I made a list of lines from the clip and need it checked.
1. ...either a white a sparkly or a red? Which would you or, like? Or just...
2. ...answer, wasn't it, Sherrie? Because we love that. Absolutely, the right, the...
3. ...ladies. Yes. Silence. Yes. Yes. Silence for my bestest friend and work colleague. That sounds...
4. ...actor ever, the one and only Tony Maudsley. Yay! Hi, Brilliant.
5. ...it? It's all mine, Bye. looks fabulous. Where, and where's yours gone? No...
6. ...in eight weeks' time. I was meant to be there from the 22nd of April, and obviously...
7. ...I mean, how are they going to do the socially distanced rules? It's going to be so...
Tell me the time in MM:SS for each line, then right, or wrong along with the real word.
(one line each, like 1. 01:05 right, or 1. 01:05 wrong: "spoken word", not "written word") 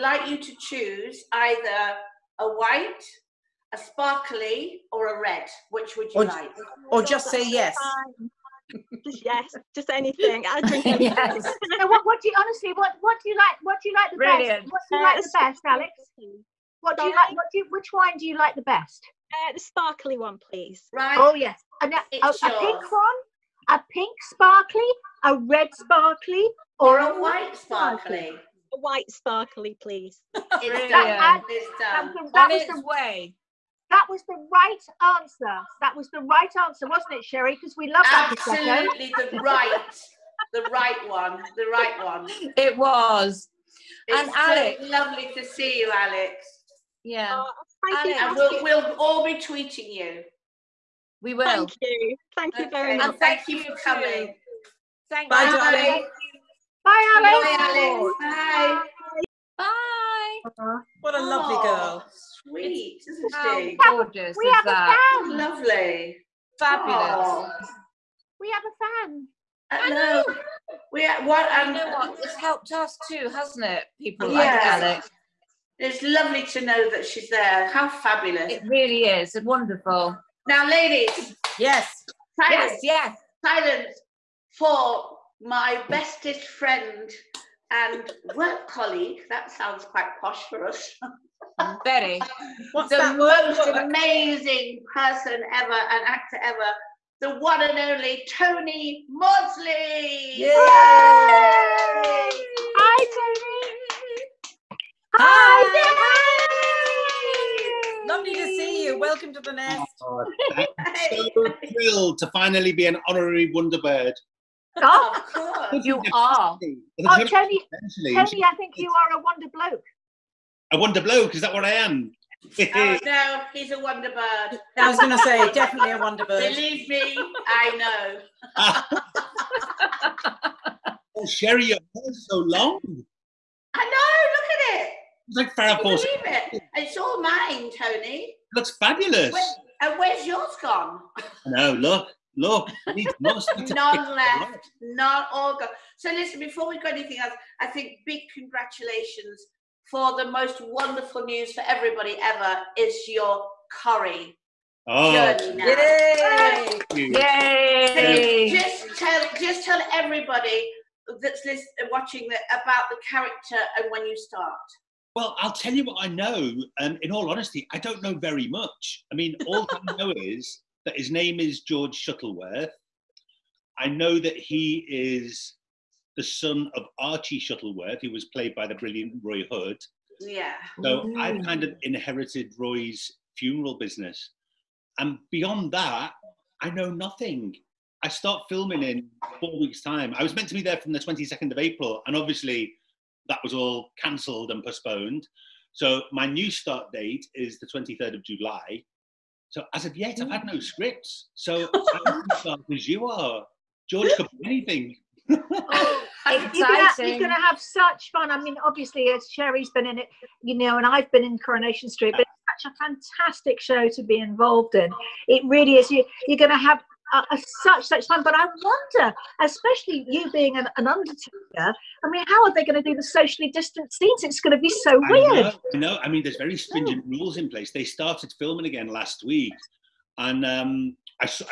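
1. 00:01 right
2. 00:36 right
3. 01:20 right
4. 01:36 wrong: "Tony", not "Brilliant"
5. 02:16 wrong: "Tony", not "Bye"
6. 03:08 wrong: "four", not "eight"
7. 03:42 wrong: "scenes", not "rules".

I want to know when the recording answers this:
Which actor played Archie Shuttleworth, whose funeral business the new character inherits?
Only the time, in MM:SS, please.
02:59.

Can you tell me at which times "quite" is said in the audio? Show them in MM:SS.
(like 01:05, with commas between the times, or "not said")
01:29.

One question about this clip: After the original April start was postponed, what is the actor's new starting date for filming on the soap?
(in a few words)
23rd of July.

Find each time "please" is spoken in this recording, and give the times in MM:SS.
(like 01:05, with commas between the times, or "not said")
00:20, 00:29.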